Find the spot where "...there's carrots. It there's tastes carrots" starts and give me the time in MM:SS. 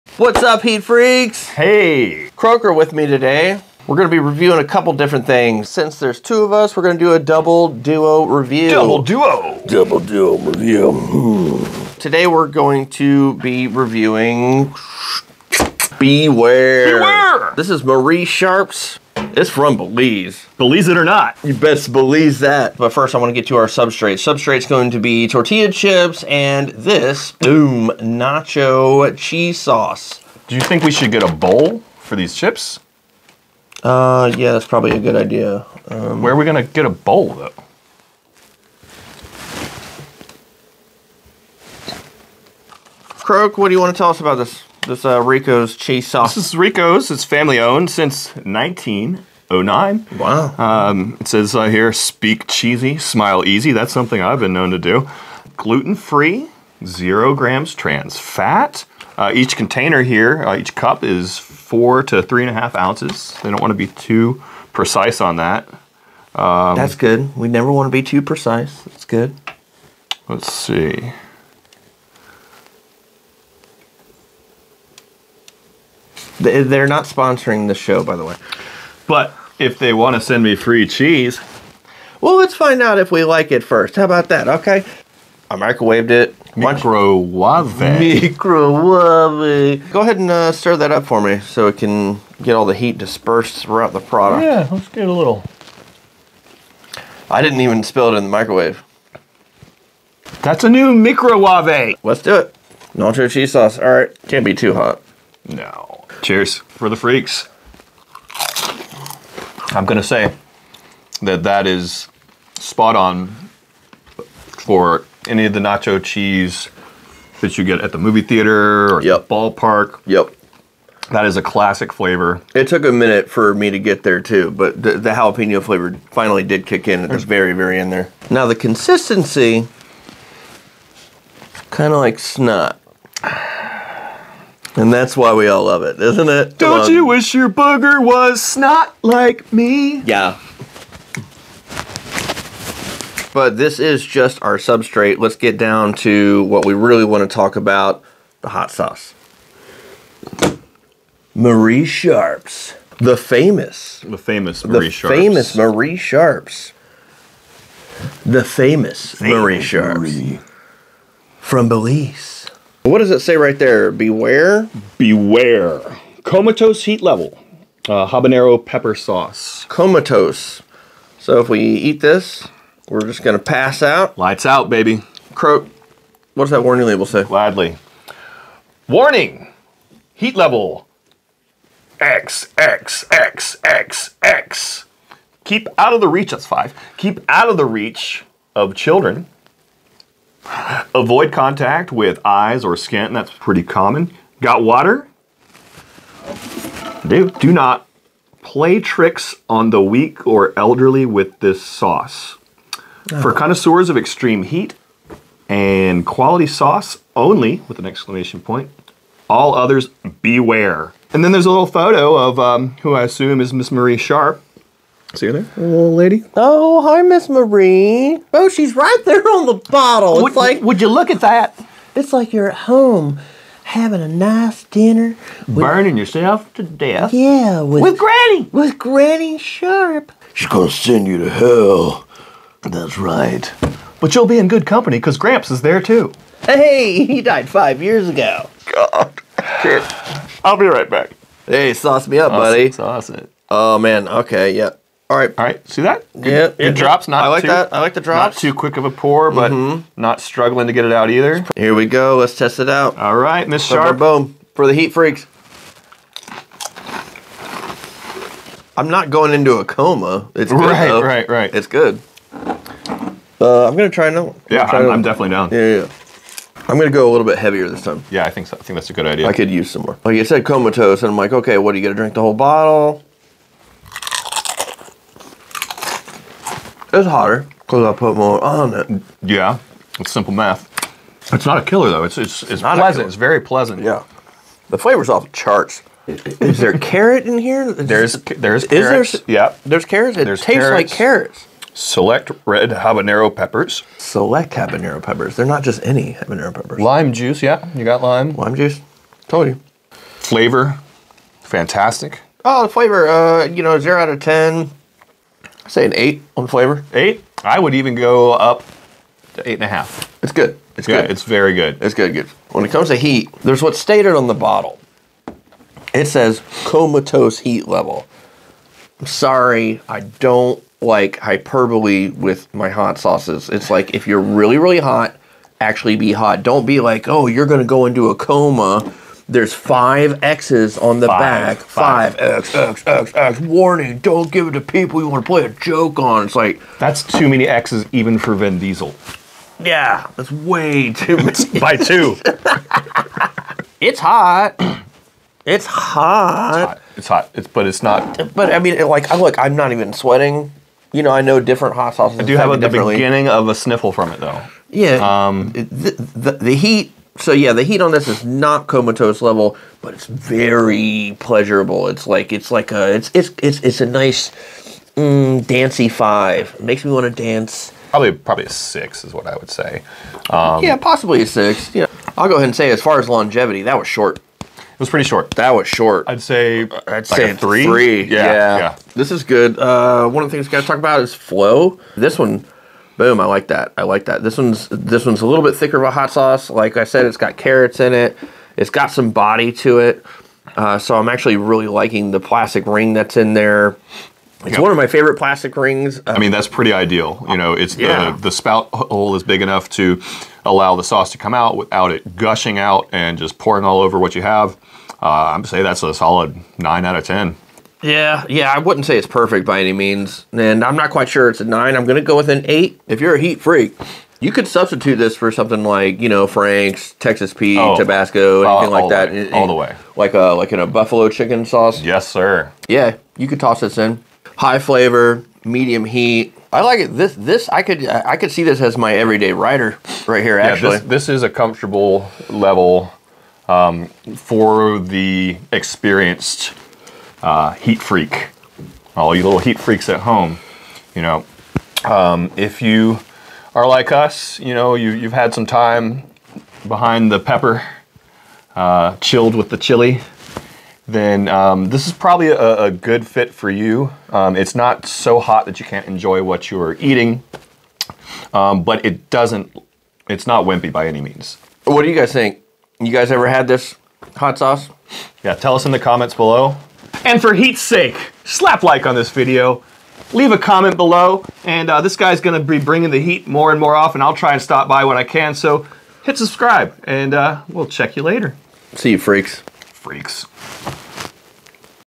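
04:49.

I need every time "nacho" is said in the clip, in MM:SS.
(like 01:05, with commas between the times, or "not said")
00:27, 01:42, 01:55.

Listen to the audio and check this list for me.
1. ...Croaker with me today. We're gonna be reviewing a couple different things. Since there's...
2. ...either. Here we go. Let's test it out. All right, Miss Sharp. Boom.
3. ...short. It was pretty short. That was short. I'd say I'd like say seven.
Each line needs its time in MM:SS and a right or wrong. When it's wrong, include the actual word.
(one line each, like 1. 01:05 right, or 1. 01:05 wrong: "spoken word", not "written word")
1. 00:02 right
2. 04:11 right
3. 06:13 wrong: "three", not "seven".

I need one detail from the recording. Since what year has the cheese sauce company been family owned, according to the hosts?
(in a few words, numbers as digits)
1909.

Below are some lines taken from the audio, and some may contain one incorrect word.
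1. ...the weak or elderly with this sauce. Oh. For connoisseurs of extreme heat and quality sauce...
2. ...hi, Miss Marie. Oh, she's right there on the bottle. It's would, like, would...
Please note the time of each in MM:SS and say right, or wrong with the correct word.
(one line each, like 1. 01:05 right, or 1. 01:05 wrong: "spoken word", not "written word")
1. 03:19 right
2. 03:36 right.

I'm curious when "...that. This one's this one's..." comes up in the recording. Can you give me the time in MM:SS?
06:24.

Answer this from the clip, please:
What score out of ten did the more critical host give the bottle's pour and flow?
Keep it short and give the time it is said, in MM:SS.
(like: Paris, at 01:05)
8, at 06:51.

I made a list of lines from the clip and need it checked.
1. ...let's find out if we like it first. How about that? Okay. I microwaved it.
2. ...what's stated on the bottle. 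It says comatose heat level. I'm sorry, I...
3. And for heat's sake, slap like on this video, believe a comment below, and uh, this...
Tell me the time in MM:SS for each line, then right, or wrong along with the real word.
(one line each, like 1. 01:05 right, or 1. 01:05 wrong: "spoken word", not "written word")
1. 01:22 right
2. 05:13 right
3. 07:47 wrong: "leave", not "believe".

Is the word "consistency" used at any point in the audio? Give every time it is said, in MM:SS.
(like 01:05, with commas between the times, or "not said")
02:08.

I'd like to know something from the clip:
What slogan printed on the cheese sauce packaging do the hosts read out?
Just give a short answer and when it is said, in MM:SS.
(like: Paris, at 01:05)
Speak cheesy, smile easy, at 00:51.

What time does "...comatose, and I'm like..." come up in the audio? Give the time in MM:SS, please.
04:30.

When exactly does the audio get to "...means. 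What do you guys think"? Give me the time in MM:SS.
07:41.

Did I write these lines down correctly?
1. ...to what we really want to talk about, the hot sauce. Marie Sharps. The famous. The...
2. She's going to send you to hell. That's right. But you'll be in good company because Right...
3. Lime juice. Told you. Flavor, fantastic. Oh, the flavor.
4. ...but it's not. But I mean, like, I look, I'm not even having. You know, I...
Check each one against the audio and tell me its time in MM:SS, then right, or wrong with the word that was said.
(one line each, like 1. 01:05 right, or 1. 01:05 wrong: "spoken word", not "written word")
1. 02:25 right
2. 03:50 wrong: "Gramps", not "Right"
3. 04:58 right
4. 05:47 wrong: "sweating", not "having".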